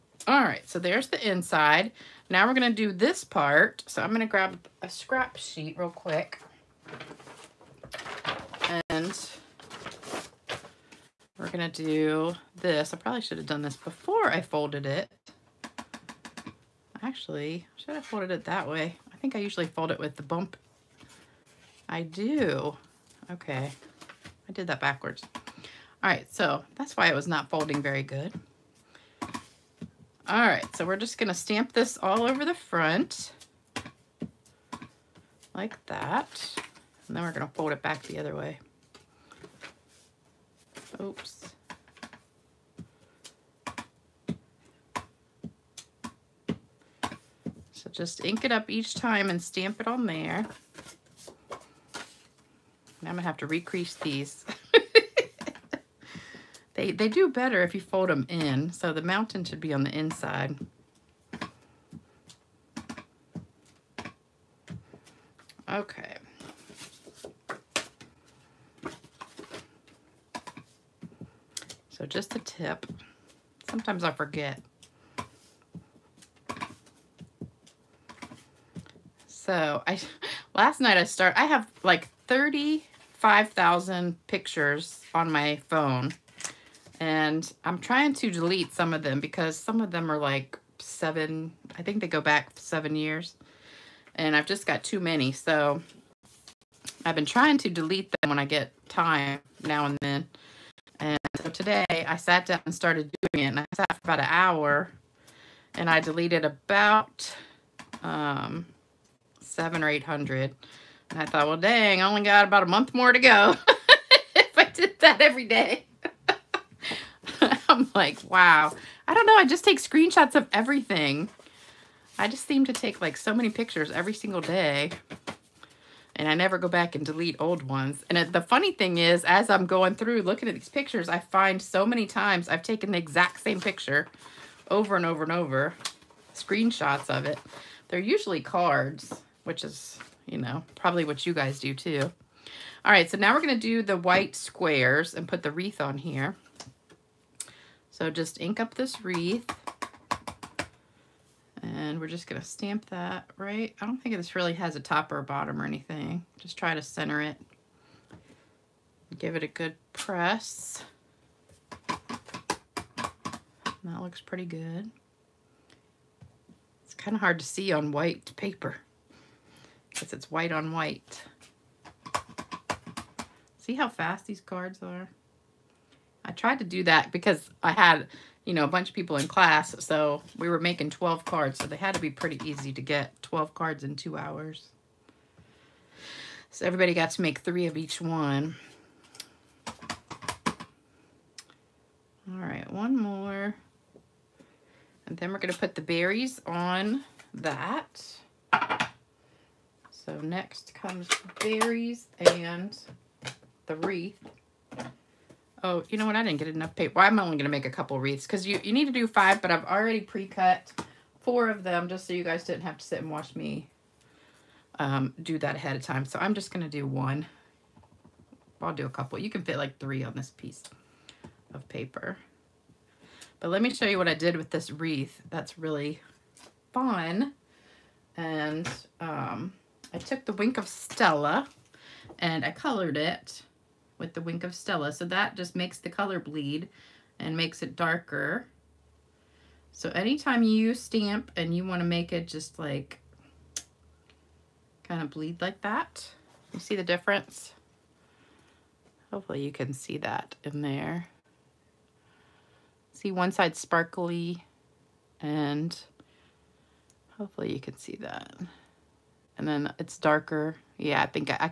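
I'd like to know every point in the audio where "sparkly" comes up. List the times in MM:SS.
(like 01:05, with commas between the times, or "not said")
04:13.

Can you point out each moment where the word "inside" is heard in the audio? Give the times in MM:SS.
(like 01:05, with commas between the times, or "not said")
00:01, 00:59.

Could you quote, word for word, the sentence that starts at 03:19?
So next comes berries and the wreath.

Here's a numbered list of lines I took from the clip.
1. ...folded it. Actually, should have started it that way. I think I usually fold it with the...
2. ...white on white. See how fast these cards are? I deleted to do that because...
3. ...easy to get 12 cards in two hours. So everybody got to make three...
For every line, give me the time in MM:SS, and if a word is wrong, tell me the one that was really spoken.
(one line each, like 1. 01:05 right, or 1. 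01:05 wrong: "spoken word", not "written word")
1. 00:14 wrong: "folded", not "started"
2. 02:50 wrong: "tried", not "deleted"
3. 03:02 right.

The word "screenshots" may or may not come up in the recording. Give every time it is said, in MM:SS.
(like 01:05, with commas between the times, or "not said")
01:59, 02:16.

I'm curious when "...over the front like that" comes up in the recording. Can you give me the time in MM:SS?
00:32.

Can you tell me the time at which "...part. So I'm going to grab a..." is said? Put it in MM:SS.
00:03.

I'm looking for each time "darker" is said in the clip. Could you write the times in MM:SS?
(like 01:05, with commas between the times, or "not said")
03:57, 04:19.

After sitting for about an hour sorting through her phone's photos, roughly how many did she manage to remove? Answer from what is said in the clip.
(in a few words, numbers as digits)
700 or 800.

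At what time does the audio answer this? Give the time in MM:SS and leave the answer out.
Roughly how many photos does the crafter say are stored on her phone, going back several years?
01:22.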